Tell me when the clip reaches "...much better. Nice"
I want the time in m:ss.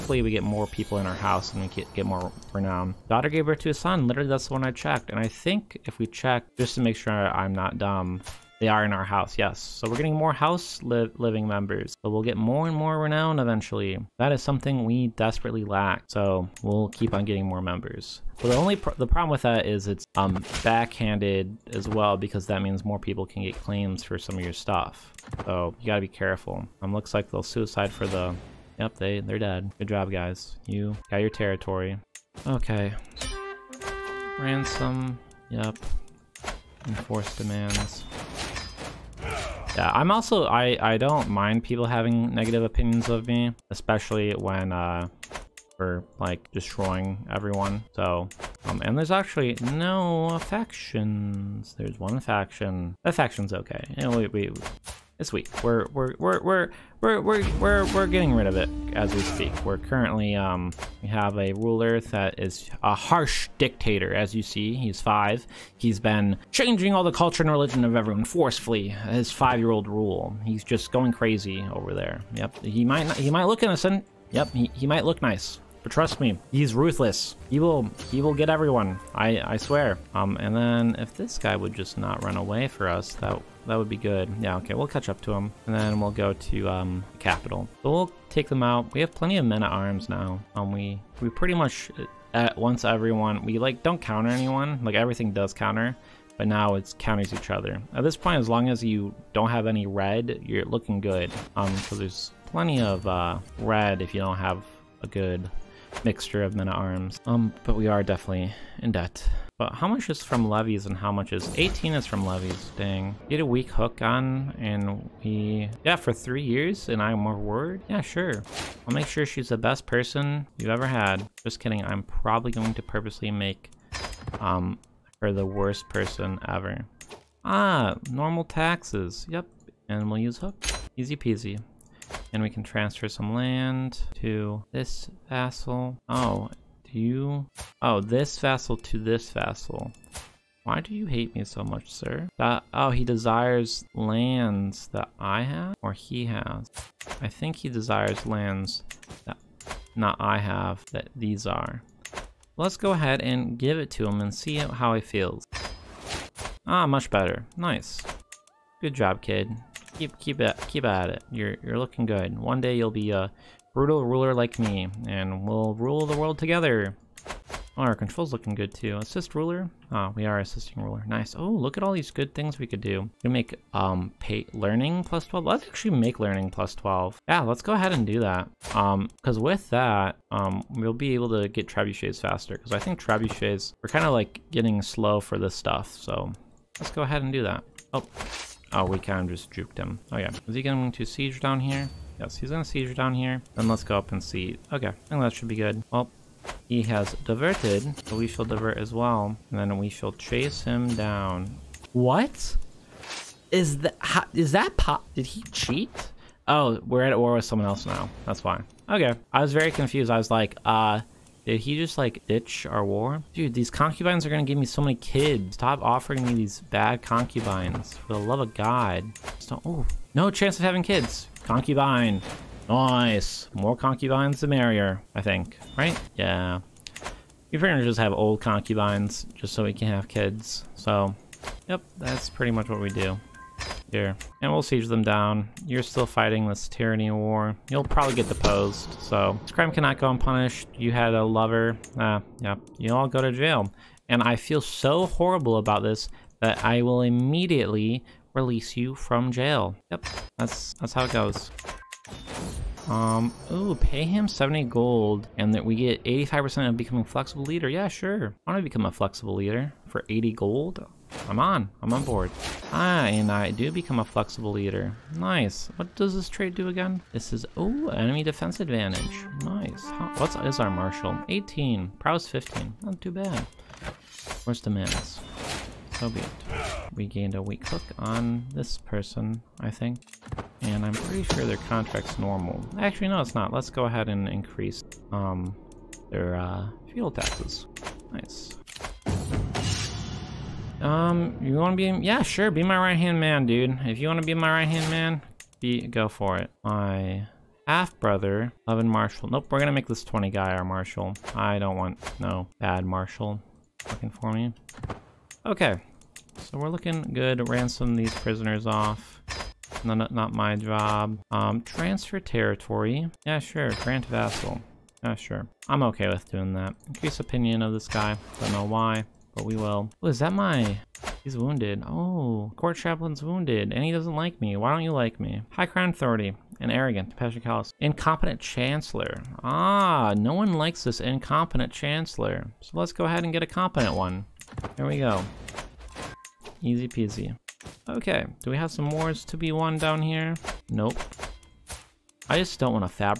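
2:36.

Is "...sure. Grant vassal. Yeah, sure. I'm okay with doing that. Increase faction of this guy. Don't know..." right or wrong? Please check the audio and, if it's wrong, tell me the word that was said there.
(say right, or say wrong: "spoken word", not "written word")
wrong: "opinion", not "faction".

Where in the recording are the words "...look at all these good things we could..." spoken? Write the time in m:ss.
2:51.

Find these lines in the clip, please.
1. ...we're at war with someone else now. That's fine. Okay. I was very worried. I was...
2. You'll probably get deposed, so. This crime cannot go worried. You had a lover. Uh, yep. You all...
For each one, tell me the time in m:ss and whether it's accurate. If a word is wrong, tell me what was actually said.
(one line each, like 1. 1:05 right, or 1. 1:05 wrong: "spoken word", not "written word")
1. 3:26 wrong: "confused", not "worried"
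2. 3:57 wrong: "unpunished", not "worried".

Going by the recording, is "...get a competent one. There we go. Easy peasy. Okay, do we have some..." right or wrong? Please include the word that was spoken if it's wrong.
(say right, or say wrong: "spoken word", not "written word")
right.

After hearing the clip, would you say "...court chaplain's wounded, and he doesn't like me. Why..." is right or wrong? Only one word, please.
right.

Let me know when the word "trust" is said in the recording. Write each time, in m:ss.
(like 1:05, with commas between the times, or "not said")
1:15.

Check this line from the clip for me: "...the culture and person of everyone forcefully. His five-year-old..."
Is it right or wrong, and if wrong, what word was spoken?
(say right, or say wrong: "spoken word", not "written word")
wrong: "religion", not "person".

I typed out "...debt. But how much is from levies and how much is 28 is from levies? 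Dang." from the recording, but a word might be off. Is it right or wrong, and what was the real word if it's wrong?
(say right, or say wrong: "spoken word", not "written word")
wrong: "18", not "28".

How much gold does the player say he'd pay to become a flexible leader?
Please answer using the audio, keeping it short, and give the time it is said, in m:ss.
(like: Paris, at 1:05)
80 gold, at 4:20.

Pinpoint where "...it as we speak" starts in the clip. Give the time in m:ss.
0:58.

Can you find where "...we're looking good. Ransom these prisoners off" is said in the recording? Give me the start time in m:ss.
5:06.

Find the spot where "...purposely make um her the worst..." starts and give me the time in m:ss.
2:02.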